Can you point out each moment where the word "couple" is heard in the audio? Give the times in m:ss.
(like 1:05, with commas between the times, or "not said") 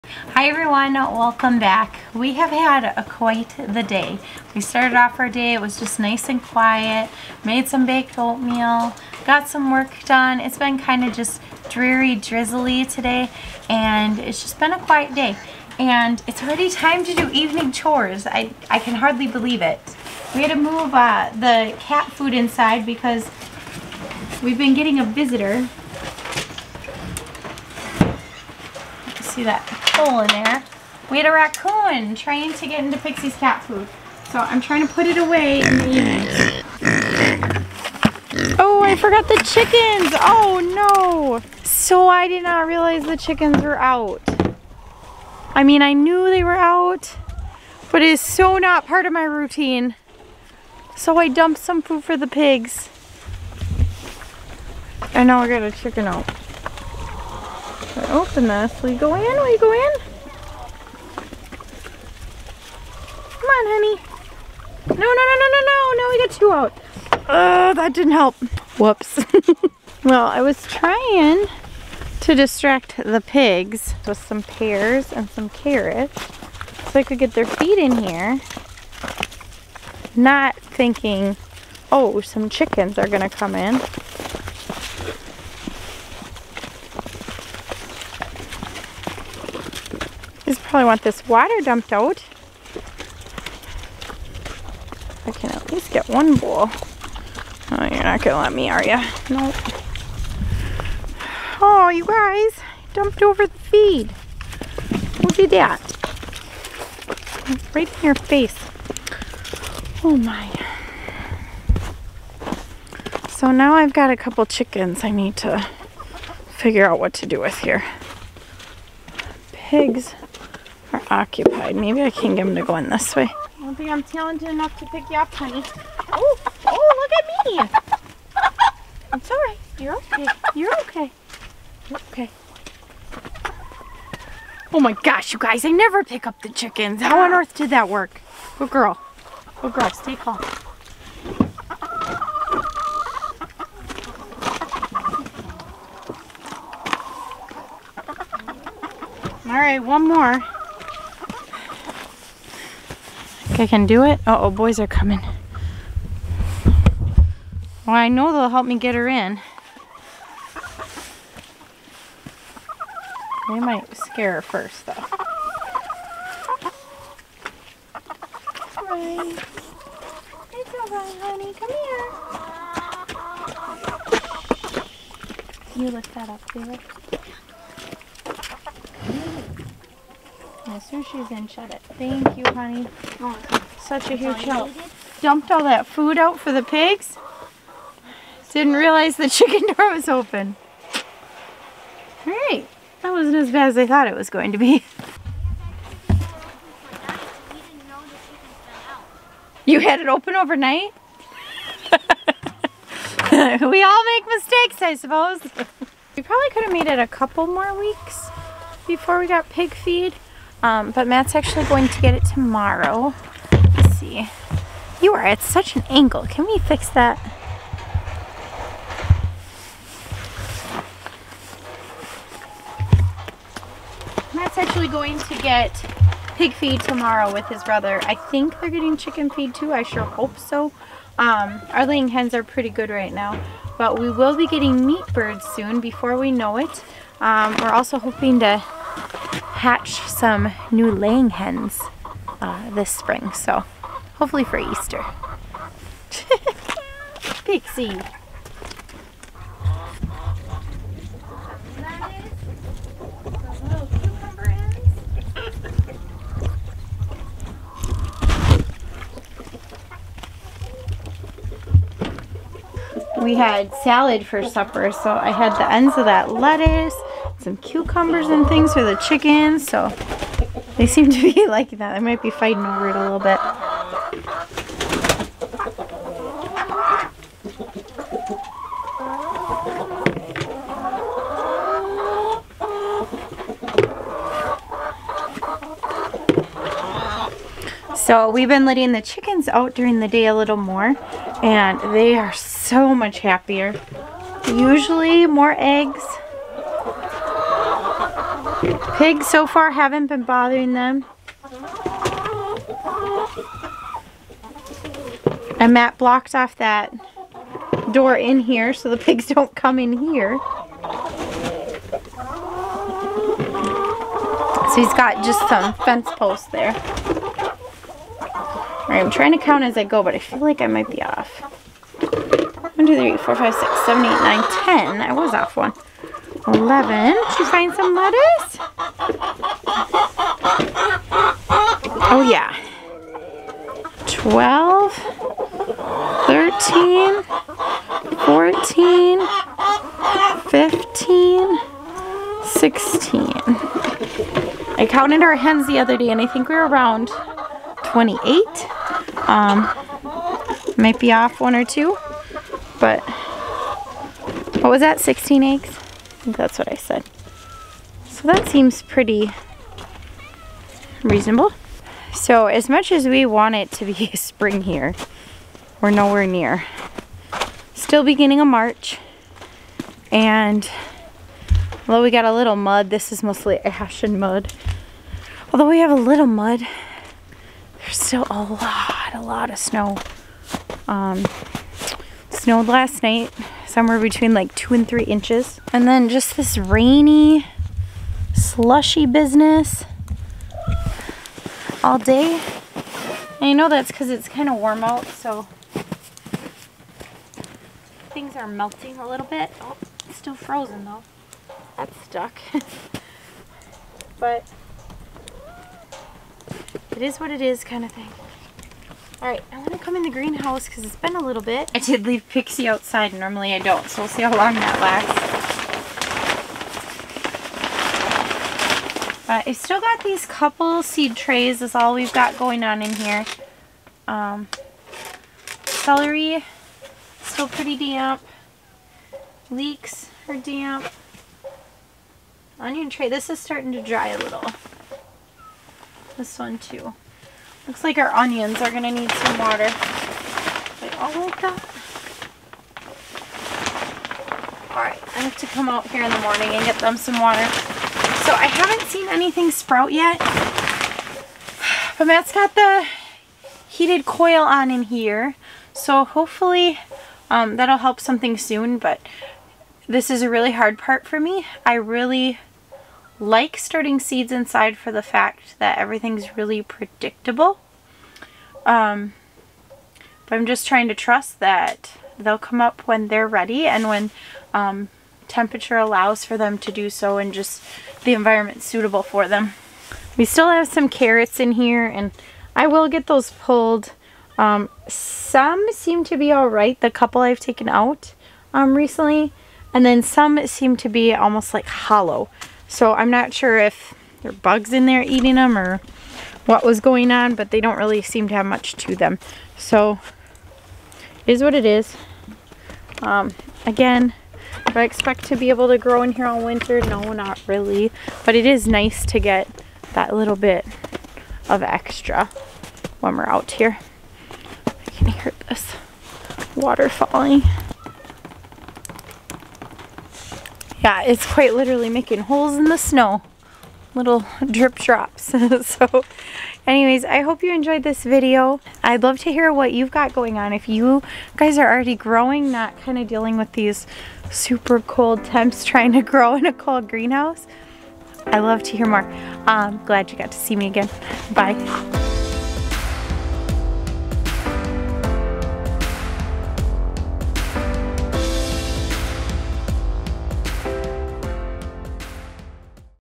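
1:54, 3:27, 7:00, 8:06.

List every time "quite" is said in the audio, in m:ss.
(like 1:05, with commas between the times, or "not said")
0:03, 8:41.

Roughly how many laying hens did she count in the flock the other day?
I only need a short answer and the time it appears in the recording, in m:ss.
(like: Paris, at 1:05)
28, at 5:47.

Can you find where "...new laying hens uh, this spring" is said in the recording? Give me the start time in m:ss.
4:00.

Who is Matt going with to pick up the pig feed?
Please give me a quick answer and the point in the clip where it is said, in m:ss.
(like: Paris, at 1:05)
His brother, at 3:47.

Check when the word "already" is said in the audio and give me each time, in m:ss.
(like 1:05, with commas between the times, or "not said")
0:16, 8:51.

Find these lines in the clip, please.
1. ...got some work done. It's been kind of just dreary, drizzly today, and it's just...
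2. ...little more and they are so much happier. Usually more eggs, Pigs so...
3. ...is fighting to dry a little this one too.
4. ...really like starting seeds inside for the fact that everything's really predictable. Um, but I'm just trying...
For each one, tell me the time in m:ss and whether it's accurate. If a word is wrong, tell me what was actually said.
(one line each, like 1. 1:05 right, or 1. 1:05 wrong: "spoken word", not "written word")
1. 0:09 right
2. 4:50 right
3. 7:13 wrong: "starting", not "fighting"
4. 7:41 right.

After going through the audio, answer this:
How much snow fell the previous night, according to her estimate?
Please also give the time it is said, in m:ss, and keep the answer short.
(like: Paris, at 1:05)
2 to 3 inches, at 6:24.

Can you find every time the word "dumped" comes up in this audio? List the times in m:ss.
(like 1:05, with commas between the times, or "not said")
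0:51, 1:31, 1:42, 3:05.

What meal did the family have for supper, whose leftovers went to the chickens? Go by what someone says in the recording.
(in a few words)
Salad.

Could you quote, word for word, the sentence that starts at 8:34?
I can hear this water falling.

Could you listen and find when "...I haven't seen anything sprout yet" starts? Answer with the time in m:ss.
7:28.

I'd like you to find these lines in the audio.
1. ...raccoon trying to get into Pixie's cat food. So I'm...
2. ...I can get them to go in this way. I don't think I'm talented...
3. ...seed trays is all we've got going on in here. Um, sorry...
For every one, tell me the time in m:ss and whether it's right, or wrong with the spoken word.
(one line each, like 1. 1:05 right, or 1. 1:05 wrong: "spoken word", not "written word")
1. 0:31 right
2. 2:02 right
3. 7:00 wrong: "celery", not "sorry".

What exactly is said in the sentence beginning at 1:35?
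I can at least get one bowl.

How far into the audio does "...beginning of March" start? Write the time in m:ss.
6:08.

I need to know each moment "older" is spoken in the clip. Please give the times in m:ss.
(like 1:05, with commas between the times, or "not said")
not said.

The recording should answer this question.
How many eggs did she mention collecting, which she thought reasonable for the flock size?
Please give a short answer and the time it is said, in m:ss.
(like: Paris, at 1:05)
16, at 5:54.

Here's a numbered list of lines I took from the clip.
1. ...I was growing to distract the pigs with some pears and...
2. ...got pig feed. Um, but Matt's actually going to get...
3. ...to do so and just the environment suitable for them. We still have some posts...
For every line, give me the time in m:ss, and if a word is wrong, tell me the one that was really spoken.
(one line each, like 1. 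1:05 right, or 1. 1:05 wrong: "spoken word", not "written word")
1. 1:10 wrong: "trying", not "growing"
2. 3:29 right
3. 7:56 wrong: "carrots", not "posts".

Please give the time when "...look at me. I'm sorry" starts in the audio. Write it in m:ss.
2:07.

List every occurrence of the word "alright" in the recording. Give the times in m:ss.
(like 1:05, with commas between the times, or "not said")
2:50, 7:24.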